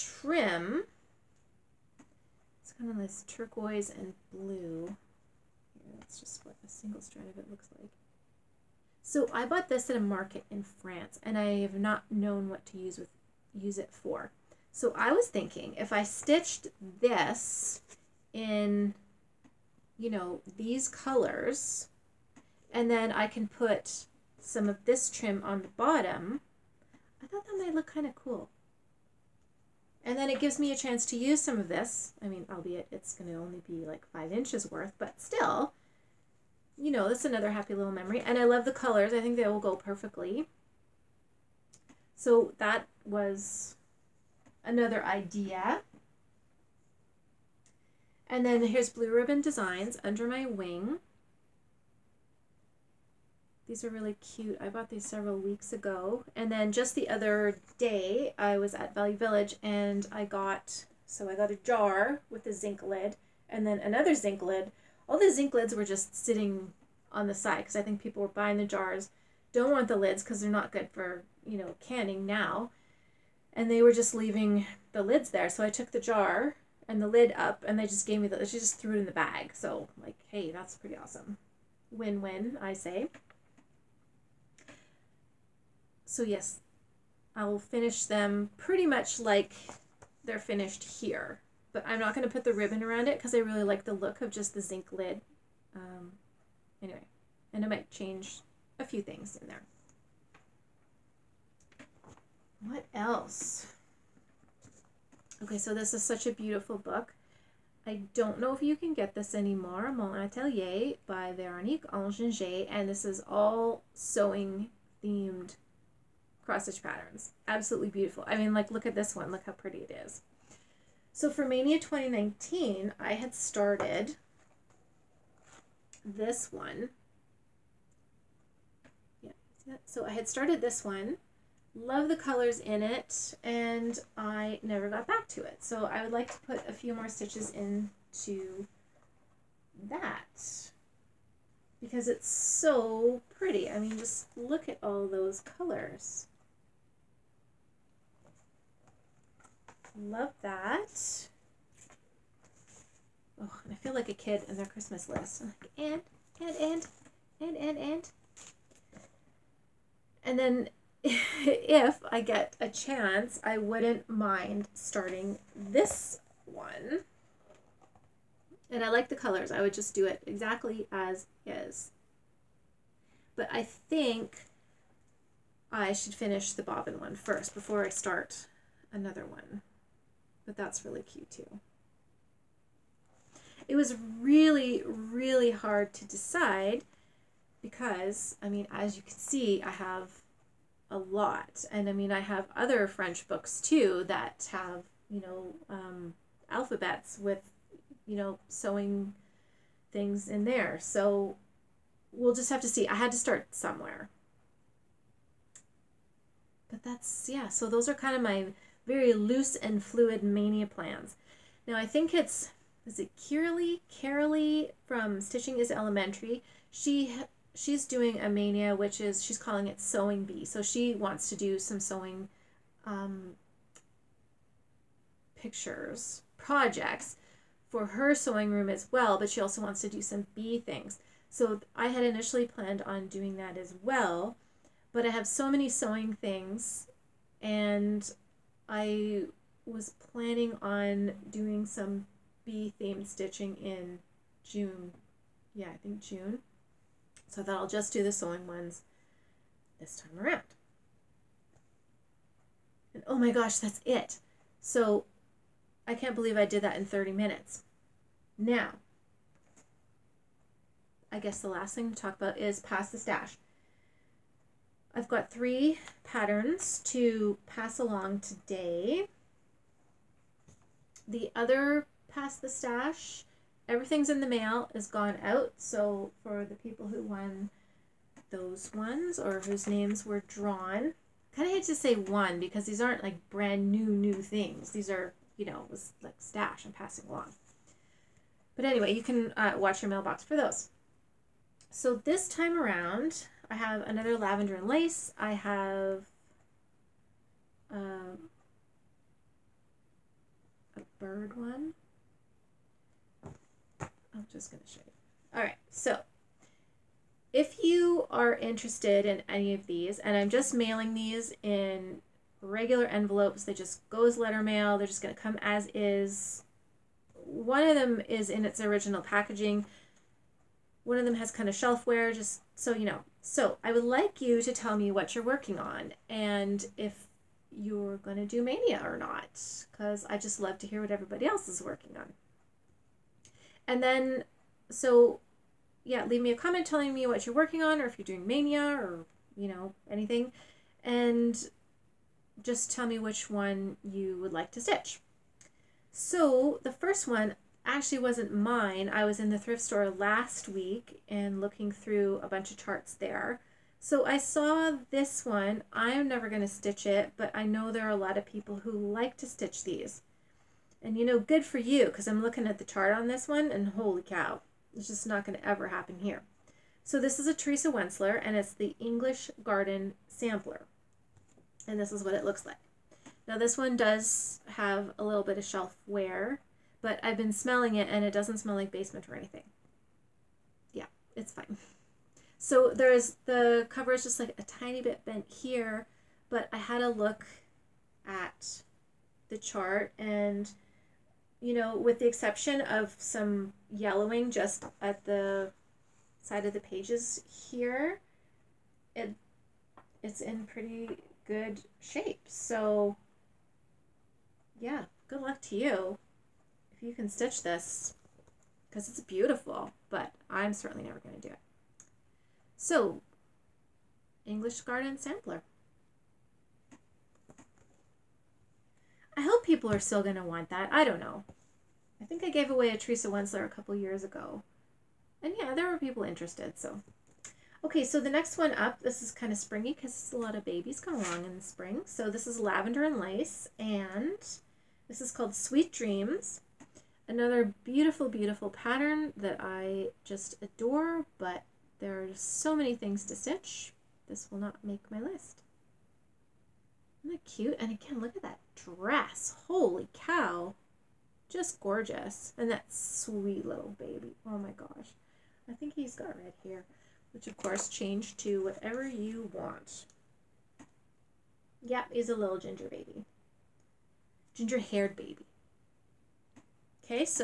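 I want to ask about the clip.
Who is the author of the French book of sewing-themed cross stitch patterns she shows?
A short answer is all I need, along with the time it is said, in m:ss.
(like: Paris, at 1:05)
Veronique Enginger, at 1:51.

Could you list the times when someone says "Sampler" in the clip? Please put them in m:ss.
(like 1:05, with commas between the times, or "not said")
6:10, 6:54.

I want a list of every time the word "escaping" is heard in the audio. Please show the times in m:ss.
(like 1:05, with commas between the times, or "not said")
not said.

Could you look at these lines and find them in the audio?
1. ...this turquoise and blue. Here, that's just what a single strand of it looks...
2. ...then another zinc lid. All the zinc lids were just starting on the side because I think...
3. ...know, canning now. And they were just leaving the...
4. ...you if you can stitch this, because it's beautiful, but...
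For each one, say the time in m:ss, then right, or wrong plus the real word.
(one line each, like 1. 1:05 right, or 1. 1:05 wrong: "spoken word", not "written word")
1. 0:02 right
2. 1:03 wrong: "sitting", not "starting"
3. 1:11 right
4. 6:45 right.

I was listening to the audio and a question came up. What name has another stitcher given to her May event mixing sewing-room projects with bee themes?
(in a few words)
sewing bee.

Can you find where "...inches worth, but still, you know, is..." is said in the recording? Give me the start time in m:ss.
0:34.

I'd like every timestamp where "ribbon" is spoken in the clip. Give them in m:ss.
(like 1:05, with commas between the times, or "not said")
0:49, 1:32.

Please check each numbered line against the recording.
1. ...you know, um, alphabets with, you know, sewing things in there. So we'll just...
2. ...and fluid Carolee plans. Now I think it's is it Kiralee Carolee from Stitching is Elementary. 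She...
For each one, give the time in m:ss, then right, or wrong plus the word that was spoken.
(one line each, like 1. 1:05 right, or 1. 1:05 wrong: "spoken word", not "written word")
1. 3:15 right
2. 3:29 wrong: "Maynia", not "Carolee".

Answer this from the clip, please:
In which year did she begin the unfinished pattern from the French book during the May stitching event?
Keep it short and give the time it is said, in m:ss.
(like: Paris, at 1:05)
2019, at 2:01.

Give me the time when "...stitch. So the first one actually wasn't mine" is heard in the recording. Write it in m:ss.
5:44.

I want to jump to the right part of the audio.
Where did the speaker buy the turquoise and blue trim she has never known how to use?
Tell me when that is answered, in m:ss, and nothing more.
0:10.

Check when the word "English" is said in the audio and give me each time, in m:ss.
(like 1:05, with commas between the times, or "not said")
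6:08, 6:54.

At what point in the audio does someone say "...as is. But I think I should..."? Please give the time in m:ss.
2:50.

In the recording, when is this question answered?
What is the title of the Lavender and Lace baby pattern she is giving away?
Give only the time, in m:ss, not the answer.
7:15.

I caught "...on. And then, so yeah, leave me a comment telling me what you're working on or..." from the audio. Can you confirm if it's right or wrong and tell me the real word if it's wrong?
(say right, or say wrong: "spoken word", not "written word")
right.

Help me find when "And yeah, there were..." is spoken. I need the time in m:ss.
7:05.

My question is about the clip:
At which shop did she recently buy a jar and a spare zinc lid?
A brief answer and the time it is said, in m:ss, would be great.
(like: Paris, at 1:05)
Valley Village, at 0:58.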